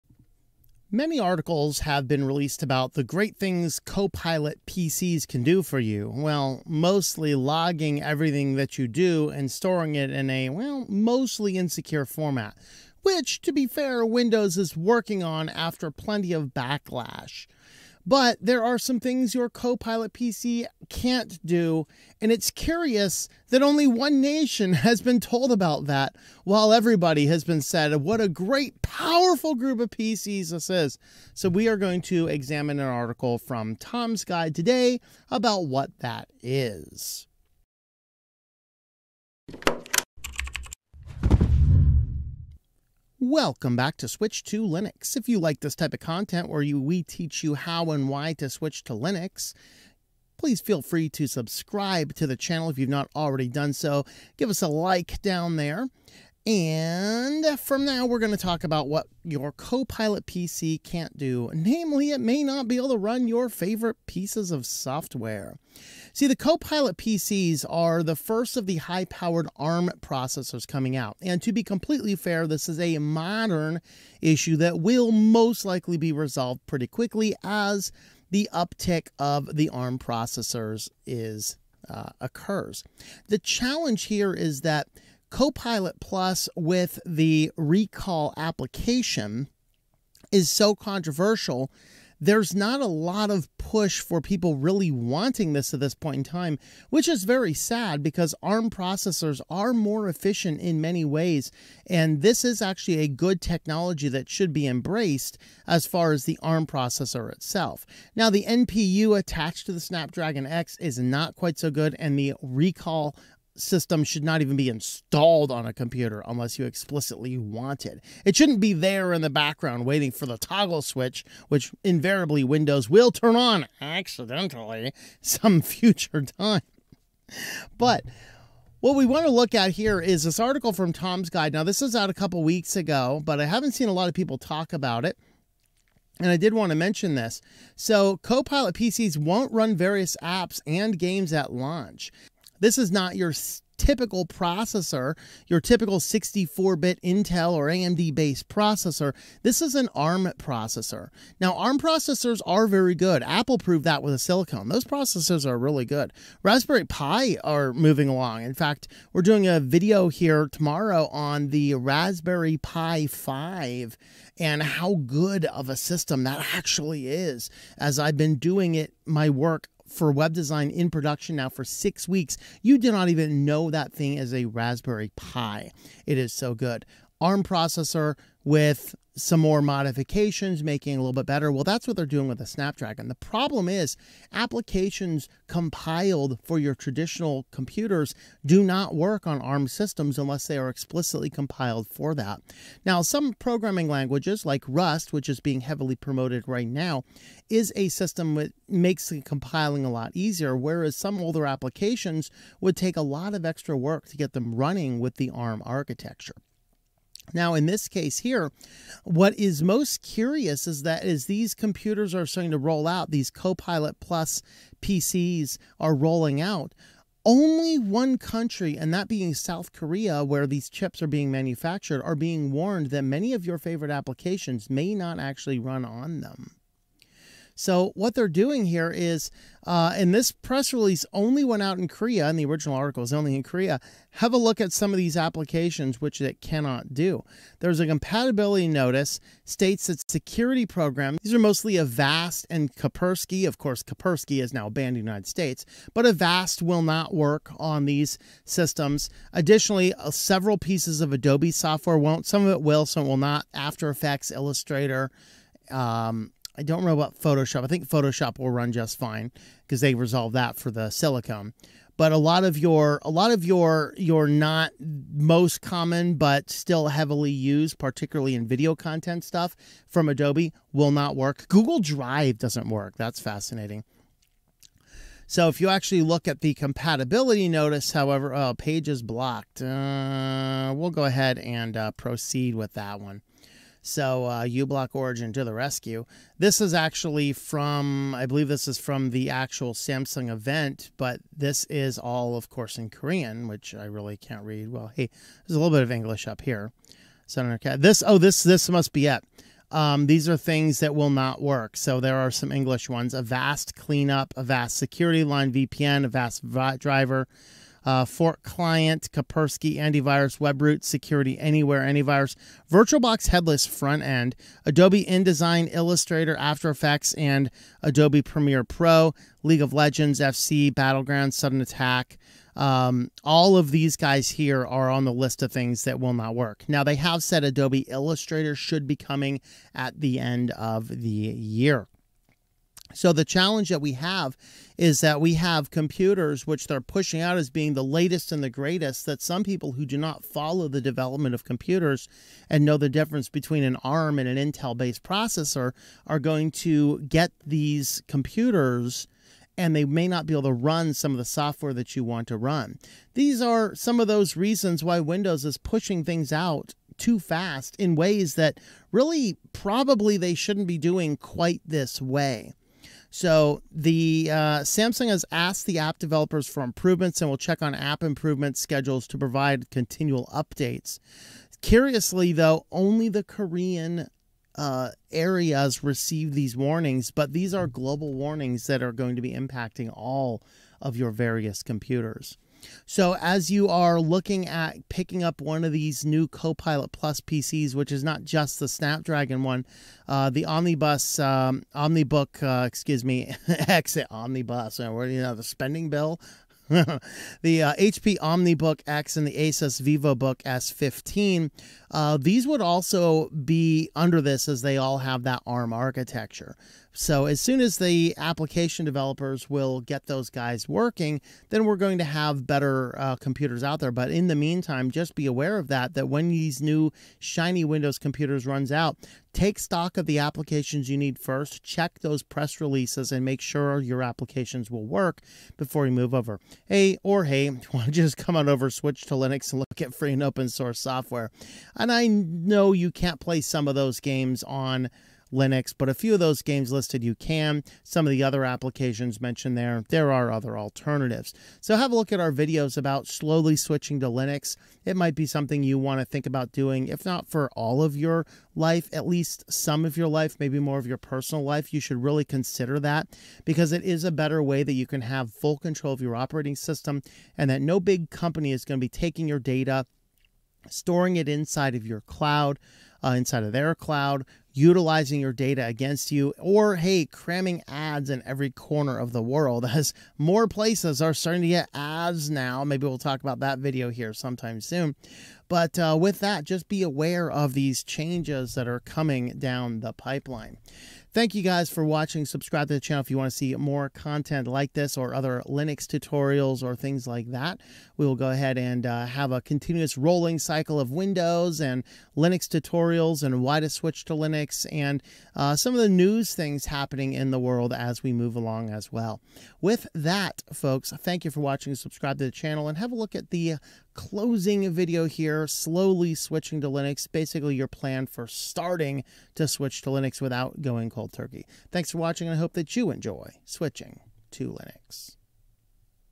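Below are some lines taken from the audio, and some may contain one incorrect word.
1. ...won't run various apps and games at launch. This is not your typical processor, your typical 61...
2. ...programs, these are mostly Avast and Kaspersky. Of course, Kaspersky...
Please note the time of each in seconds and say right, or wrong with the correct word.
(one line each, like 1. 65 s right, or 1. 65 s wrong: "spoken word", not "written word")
1. 139 s wrong: "64", not "61"
2. 240 s right.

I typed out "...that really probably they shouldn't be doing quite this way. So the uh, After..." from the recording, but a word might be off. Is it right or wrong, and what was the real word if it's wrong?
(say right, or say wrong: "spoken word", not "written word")
wrong: "Samsung", not "After".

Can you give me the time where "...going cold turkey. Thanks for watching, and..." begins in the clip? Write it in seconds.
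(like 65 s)
510 s.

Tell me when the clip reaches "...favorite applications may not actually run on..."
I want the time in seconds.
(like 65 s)
223 s.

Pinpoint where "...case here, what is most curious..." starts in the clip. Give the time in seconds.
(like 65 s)
207 s.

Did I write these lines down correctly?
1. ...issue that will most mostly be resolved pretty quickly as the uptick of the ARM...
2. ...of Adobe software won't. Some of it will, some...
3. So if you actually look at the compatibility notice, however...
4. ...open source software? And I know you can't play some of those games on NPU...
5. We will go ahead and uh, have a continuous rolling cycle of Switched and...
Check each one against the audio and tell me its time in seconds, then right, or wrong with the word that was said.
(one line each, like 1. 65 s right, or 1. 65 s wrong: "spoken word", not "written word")
1. 74 s wrong: "likely", not "mostly"
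2. 250 s right
3. 275 s right
4. 430 s wrong: "Linux", not "NPU"
5. 487 s wrong: "Windows", not "Switched".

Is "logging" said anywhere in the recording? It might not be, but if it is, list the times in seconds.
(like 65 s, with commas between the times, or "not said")
7 s.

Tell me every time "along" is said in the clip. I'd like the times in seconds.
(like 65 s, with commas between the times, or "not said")
158 s, 498 s.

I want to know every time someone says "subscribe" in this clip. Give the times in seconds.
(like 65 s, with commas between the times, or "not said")
51 s, 482 s, 501 s.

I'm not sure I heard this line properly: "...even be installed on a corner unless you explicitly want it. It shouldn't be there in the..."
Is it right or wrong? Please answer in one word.
wrong.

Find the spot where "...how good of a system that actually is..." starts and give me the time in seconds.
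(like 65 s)
164 s.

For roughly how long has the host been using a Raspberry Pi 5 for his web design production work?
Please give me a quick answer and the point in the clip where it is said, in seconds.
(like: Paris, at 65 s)
6 weeks, at 171 s.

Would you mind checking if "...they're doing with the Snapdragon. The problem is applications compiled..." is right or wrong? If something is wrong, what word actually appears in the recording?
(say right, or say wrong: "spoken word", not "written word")
right.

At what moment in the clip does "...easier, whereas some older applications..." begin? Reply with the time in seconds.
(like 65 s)
200 s.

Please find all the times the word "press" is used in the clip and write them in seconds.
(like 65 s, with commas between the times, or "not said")
230 s, 422 s.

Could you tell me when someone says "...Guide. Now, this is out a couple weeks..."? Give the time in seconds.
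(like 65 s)
131 s.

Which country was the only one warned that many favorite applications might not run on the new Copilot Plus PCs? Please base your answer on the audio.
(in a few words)
South Korea.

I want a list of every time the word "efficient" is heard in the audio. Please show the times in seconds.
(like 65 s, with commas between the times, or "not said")
100 s.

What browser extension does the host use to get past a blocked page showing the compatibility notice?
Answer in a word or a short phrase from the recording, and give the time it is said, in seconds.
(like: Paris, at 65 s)
uBlock Origin, at 284 s.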